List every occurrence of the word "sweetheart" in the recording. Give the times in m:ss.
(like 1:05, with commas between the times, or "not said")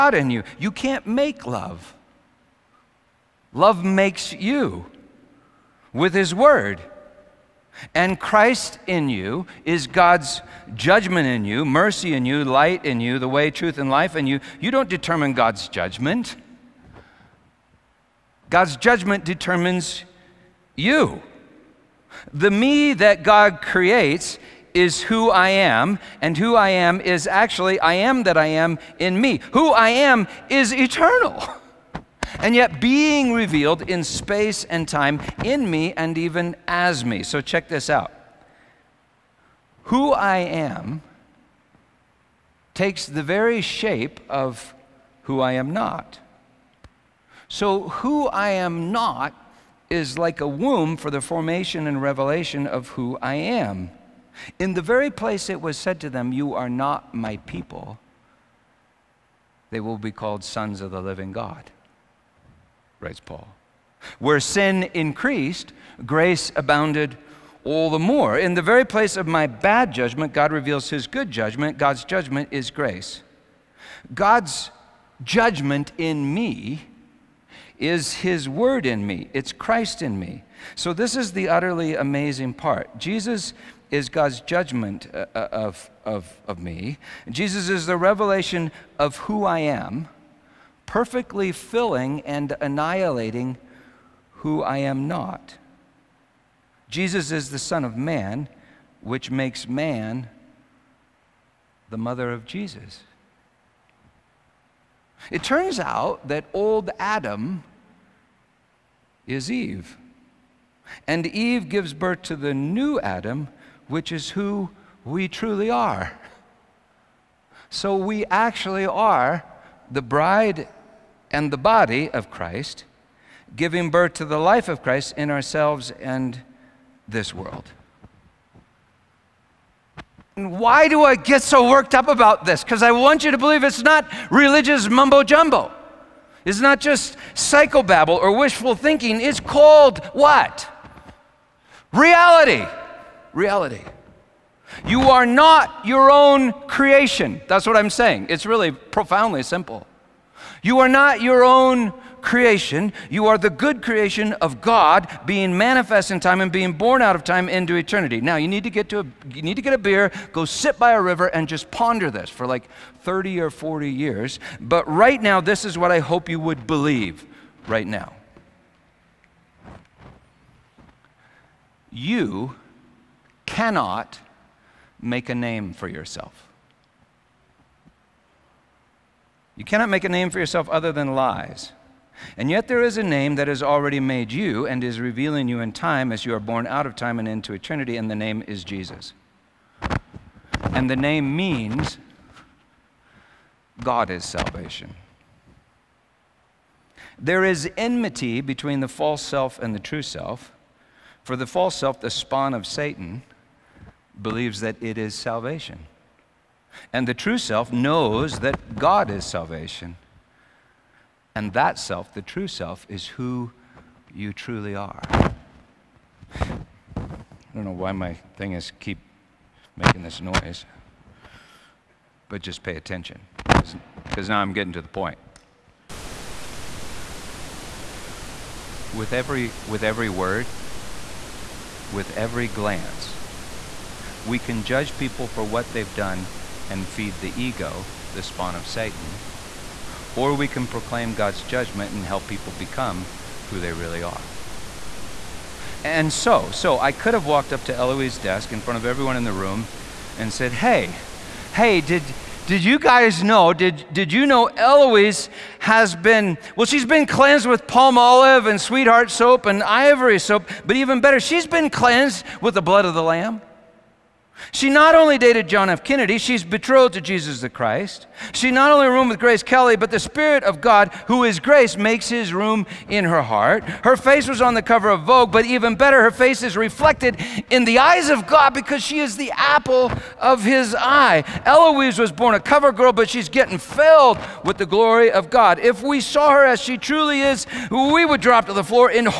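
4:18.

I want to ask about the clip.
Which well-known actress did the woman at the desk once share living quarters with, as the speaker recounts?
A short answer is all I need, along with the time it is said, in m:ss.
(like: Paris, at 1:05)
Grace Kelly, at 4:29.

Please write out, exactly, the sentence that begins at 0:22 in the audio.
The me that God creates is who I am, and who I am is actually I am that I am in me.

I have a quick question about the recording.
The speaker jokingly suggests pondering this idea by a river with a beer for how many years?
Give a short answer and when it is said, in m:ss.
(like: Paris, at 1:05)
30 or 40 years, at 2:43.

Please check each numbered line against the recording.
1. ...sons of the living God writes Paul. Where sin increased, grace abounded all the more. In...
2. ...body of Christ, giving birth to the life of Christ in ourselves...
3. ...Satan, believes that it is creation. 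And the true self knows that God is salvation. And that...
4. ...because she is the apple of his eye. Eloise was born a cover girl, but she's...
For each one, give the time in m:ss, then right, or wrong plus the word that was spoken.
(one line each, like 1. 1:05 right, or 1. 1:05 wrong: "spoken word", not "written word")
1. 1:00 right
2. 2:01 right
3. 3:22 wrong: "salvation", not "creation"
4. 4:38 right.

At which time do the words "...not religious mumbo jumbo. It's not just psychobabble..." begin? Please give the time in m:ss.
2:13.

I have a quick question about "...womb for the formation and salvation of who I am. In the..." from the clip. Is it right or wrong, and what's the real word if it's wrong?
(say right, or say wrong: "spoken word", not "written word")
wrong: "revelation", not "salvation".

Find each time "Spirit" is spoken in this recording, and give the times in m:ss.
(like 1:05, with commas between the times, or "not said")
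4:29.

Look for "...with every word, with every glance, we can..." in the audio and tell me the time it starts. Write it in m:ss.
3:49.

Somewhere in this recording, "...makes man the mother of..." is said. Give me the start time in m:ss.
1:39.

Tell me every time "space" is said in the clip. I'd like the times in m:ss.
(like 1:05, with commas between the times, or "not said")
0:34.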